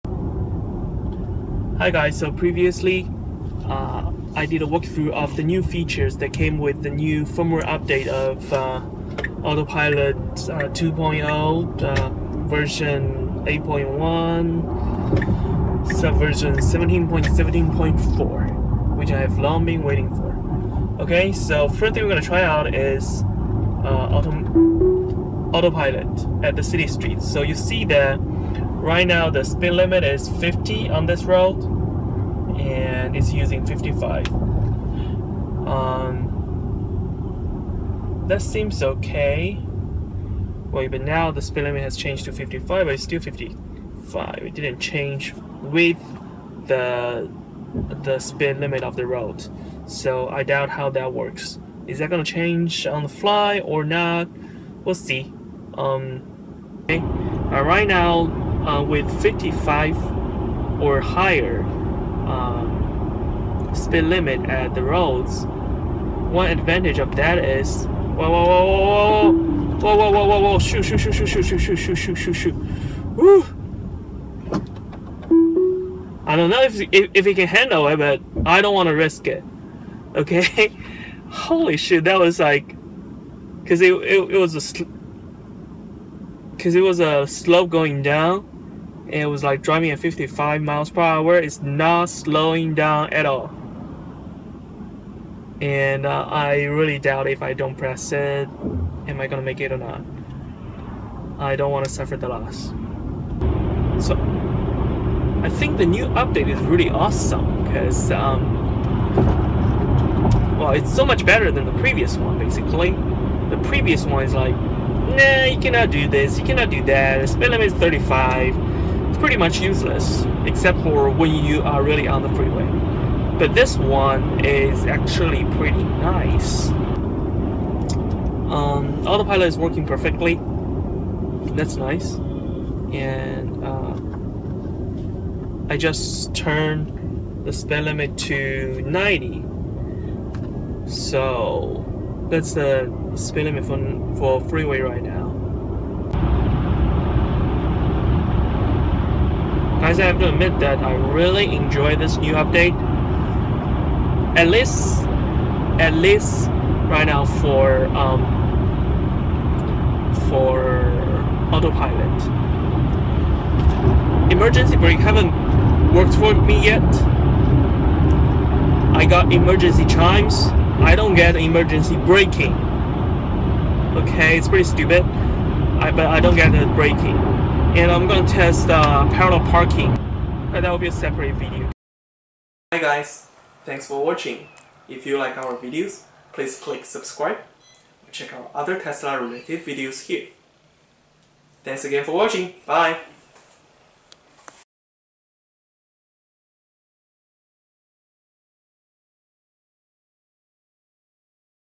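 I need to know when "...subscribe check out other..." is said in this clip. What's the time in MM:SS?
03:06.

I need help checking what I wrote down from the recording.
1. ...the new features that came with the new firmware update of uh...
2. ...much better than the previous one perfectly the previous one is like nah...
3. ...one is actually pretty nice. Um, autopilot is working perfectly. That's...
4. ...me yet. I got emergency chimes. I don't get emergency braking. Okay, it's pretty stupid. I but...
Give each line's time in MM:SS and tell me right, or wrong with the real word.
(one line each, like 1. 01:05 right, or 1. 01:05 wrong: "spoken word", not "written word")
1. 00:05 right
2. 01:51 wrong: "basically", not "perfectly"
3. 02:03 right
4. 02:46 right.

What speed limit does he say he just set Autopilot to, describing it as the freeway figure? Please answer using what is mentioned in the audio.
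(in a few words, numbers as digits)
90.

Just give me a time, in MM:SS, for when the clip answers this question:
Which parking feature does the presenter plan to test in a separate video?
02:59.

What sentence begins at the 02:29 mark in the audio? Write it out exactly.
guys, I have to admit that I really enjoy this new update.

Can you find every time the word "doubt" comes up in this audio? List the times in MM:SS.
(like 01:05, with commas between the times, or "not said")
00:50, 01:36.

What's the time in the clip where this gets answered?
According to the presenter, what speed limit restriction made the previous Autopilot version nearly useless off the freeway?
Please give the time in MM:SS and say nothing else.
01:57.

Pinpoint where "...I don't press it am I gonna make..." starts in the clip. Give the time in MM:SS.
01:37.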